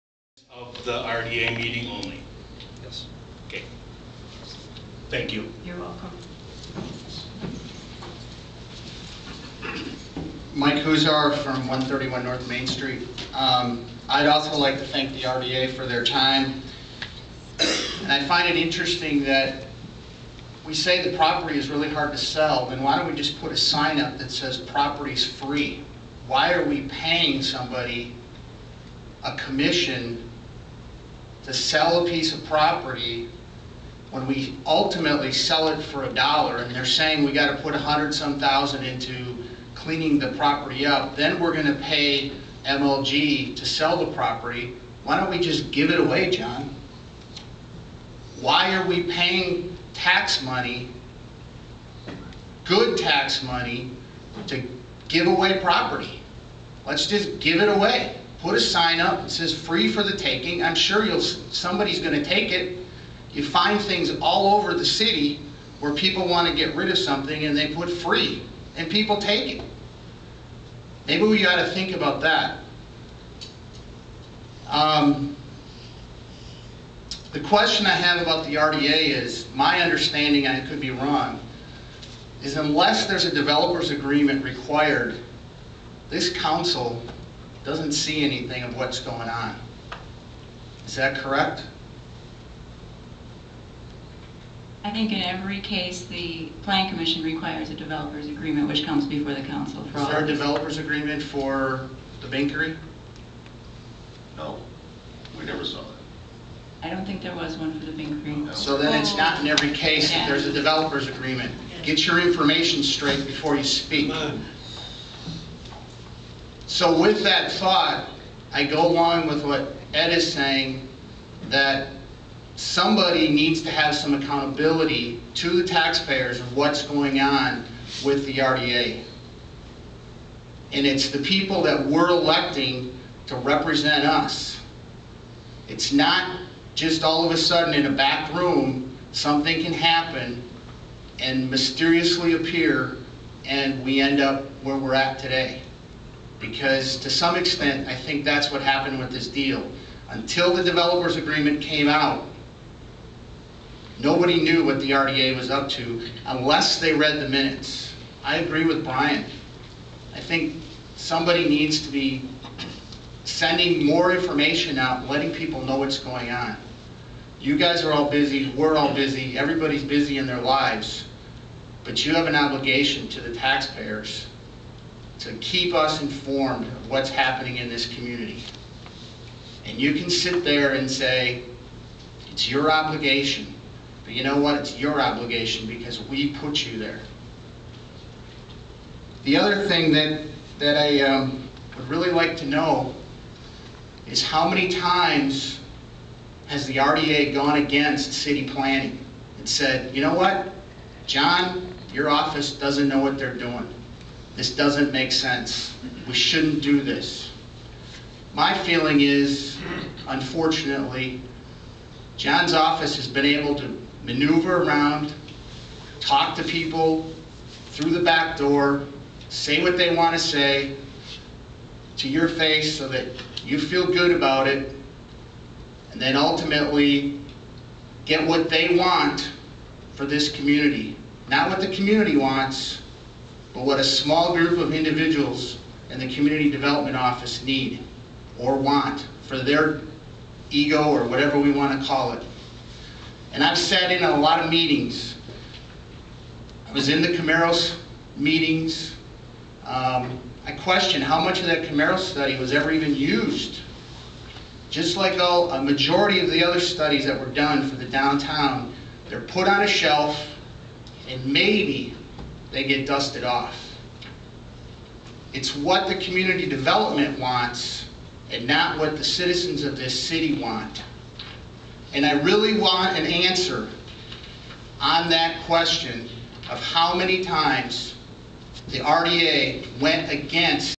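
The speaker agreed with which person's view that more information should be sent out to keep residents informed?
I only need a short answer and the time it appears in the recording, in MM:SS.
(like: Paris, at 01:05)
Brian, at 02:38.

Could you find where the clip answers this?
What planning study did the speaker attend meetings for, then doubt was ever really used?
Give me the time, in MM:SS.
04:07.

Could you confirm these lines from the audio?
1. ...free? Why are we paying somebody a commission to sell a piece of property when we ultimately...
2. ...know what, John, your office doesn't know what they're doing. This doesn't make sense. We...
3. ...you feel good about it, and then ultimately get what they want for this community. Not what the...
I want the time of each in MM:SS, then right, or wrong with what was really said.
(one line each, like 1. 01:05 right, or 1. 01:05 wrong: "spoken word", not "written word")
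1. 00:25 right
2. 03:20 right
3. 03:43 right.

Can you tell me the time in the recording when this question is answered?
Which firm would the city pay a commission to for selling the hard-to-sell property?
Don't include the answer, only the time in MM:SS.
00:42.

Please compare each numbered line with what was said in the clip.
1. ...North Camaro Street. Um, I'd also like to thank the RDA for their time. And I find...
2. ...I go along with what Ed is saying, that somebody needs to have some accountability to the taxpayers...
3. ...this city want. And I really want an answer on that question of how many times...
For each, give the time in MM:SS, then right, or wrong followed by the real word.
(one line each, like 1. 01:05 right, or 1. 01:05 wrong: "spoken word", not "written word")
1. 00:12 wrong: "Main", not "Camaro"
2. 01:58 right
3. 04:29 right.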